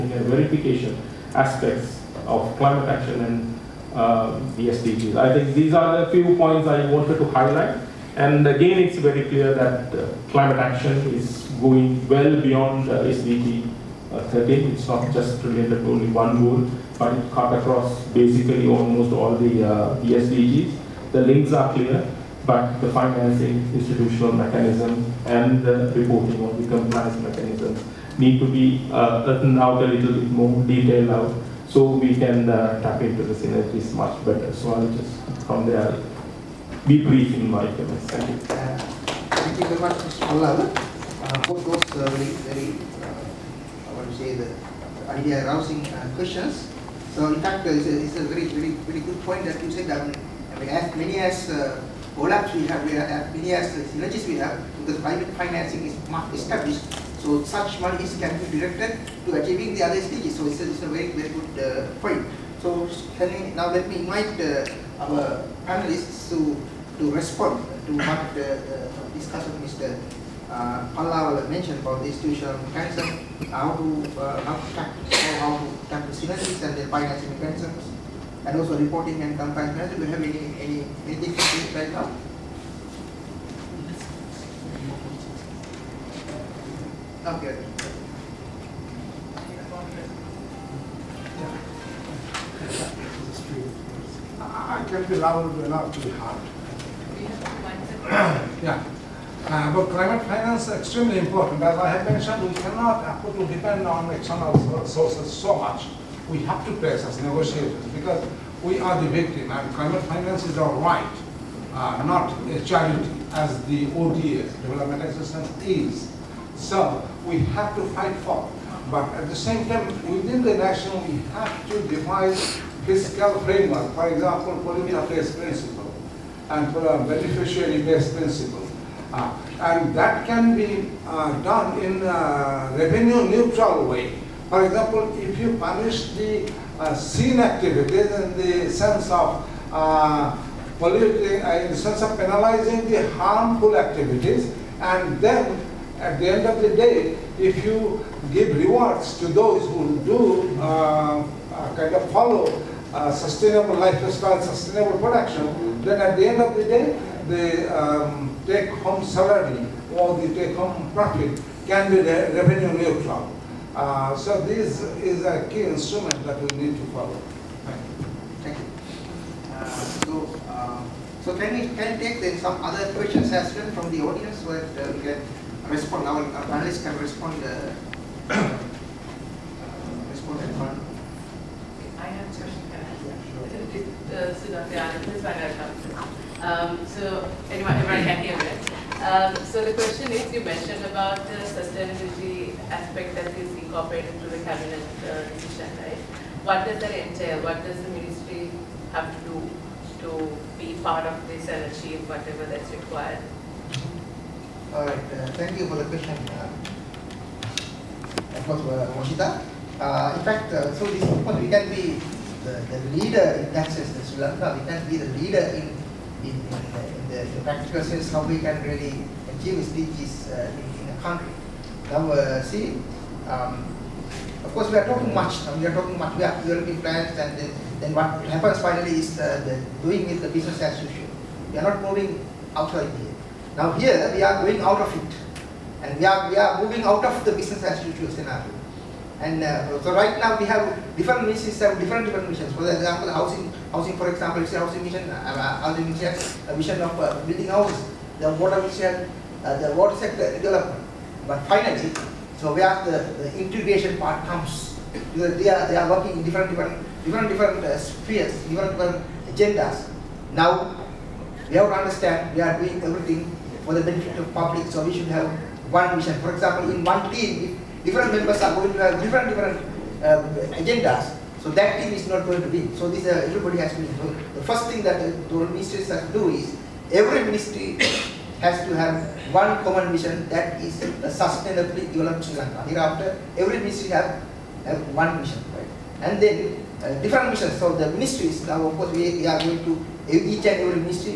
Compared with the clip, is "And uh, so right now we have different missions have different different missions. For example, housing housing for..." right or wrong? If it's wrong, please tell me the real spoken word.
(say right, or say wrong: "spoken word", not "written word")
right.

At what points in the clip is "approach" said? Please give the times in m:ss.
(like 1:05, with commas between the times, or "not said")
not said.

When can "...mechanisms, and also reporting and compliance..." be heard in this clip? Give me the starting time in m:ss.
1:17.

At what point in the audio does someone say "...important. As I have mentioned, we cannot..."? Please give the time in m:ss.
1:41.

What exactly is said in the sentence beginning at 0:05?
I think these are the few points I wanted to highlight.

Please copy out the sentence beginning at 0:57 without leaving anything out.
So such monies can be directed to achieving the other stages.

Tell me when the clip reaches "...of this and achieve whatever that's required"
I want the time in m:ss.
3:21.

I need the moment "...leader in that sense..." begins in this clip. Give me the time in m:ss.
3:32.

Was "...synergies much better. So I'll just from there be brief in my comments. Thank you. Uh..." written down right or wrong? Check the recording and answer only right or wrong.
right.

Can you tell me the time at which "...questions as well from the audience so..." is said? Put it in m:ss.
2:52.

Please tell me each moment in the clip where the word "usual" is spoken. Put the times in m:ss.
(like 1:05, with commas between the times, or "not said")
3:50, 3:57.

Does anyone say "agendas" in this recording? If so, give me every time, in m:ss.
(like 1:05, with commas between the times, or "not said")
4:19, 4:30.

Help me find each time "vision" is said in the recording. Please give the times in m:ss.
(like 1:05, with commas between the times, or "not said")
4:25, 4:39.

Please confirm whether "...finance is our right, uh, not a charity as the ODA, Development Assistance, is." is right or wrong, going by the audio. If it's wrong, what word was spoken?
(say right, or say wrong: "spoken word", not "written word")
right.